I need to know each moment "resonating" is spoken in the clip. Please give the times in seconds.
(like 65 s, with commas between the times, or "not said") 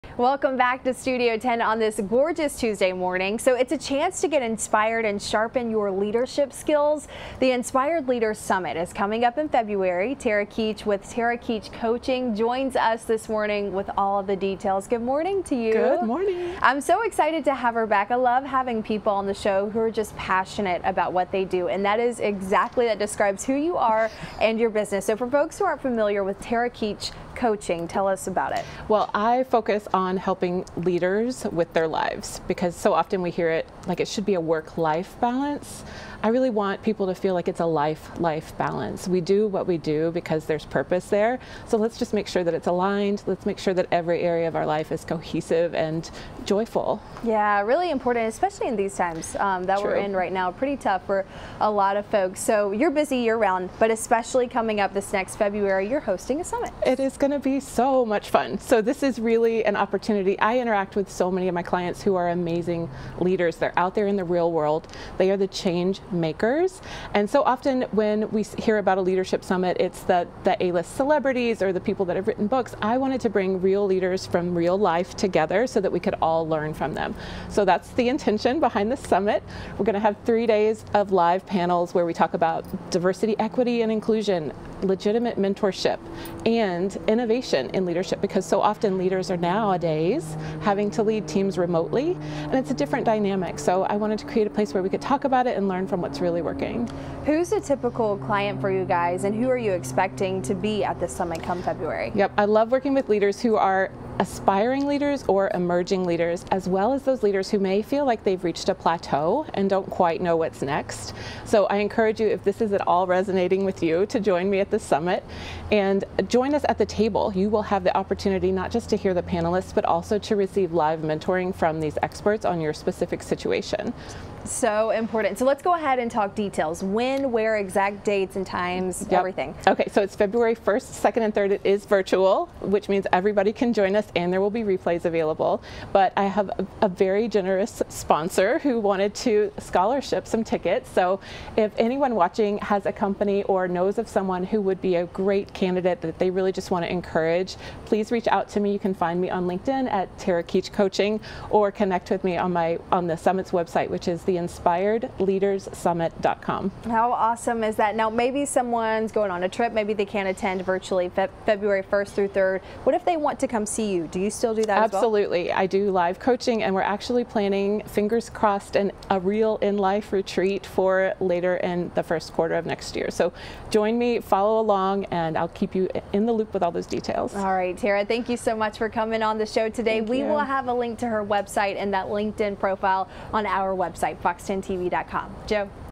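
113 s.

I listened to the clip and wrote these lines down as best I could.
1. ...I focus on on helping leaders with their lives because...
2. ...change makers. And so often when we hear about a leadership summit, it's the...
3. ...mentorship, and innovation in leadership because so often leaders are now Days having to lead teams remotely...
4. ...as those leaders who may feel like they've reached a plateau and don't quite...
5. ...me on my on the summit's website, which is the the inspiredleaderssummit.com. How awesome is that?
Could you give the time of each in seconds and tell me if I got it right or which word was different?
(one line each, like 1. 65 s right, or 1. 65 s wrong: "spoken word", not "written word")
1. 29 s right
2. 65 s right
3. 85 s right
4. 106 s right
5. 152 s right.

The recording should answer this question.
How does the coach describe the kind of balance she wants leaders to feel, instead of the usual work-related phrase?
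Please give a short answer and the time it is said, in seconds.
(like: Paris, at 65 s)
life life balance, at 37 s.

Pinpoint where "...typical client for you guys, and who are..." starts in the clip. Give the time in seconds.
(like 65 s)
97 s.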